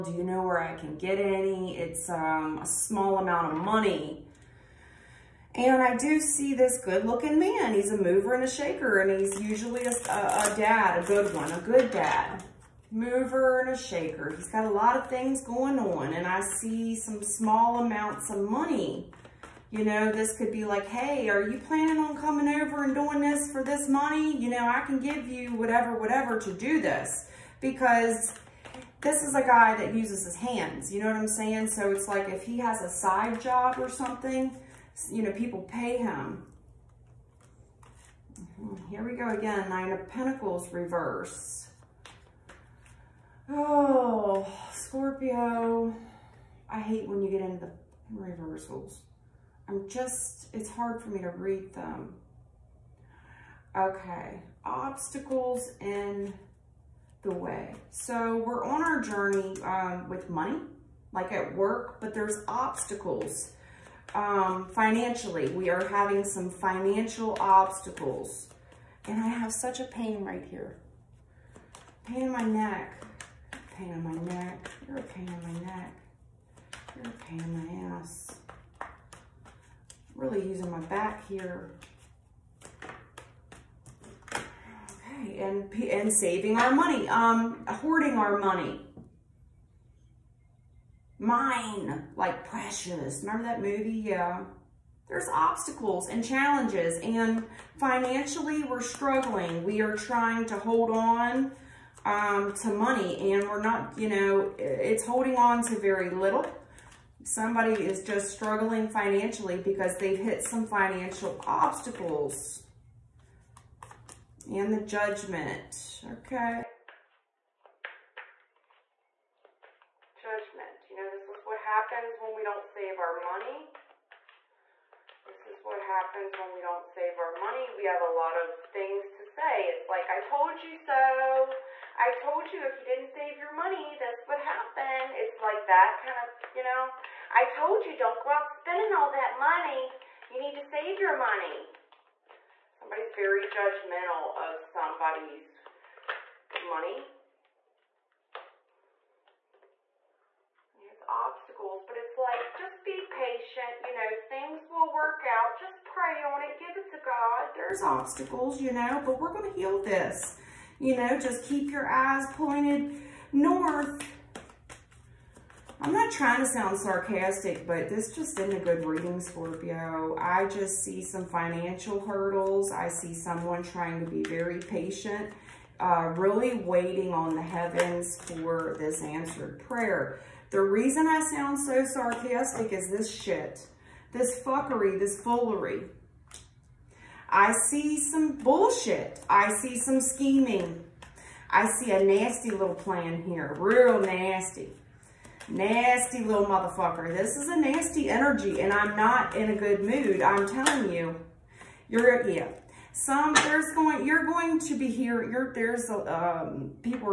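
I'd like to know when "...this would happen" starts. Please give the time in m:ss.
2:13.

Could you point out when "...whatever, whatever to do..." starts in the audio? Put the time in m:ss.
0:25.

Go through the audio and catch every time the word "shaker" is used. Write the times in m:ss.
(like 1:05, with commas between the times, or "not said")
0:08, 0:13.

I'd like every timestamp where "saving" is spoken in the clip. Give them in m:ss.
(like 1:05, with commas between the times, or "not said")
1:26.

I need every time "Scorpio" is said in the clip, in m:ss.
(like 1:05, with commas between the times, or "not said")
0:44, 2:49.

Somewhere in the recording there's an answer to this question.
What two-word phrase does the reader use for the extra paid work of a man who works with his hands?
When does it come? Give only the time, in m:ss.
0:32.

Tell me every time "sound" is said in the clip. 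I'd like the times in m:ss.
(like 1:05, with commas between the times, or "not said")
2:46, 3:01.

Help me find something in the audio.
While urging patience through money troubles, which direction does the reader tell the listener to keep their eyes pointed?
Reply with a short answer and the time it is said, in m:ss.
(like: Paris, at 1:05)
north, at 2:43.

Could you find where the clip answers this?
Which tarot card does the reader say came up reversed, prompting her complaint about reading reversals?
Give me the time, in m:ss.
0:39.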